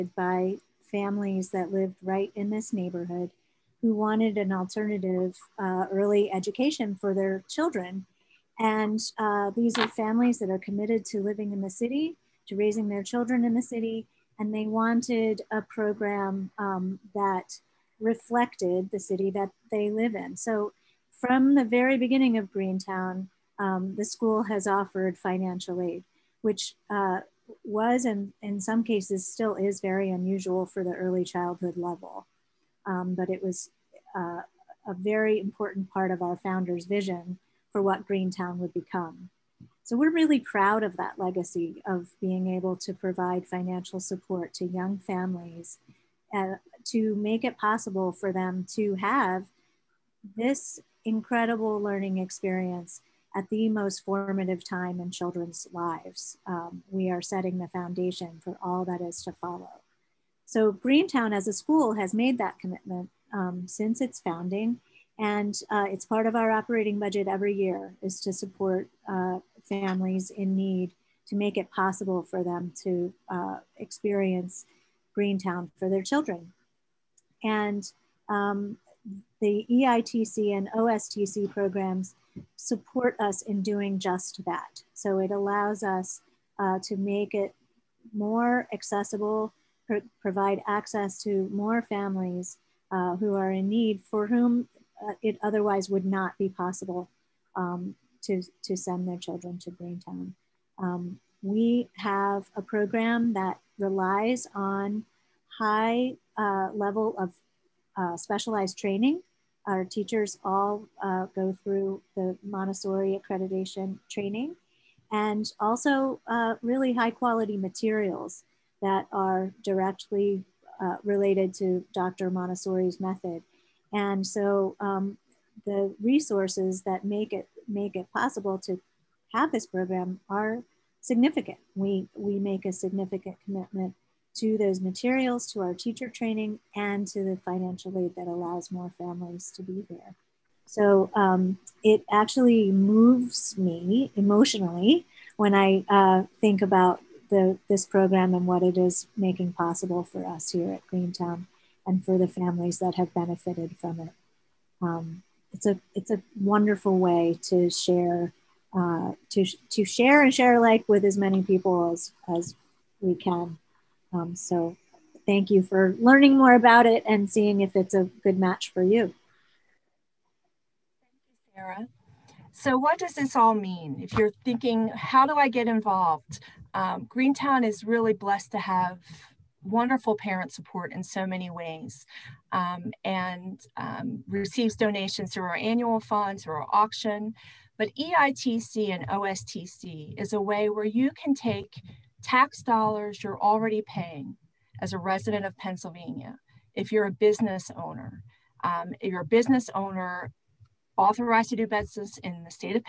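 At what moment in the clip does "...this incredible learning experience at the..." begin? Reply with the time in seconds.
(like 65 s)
50 s.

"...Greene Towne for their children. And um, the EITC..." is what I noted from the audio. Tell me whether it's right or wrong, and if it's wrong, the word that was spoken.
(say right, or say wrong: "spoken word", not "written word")
right.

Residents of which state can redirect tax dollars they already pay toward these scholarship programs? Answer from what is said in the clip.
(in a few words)
Pennsylvania.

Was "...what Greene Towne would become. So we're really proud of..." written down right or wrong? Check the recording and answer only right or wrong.
right.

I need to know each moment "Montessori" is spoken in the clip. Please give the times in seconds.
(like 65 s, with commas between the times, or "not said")
112 s, 122 s.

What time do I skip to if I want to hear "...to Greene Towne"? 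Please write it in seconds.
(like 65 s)
99 s.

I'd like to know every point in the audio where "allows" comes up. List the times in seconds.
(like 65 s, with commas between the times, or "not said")
85 s, 138 s.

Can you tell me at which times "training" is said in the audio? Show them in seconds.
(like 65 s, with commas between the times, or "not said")
108 s, 114 s, 136 s.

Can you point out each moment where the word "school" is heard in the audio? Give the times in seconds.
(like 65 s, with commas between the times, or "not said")
24 s, 61 s.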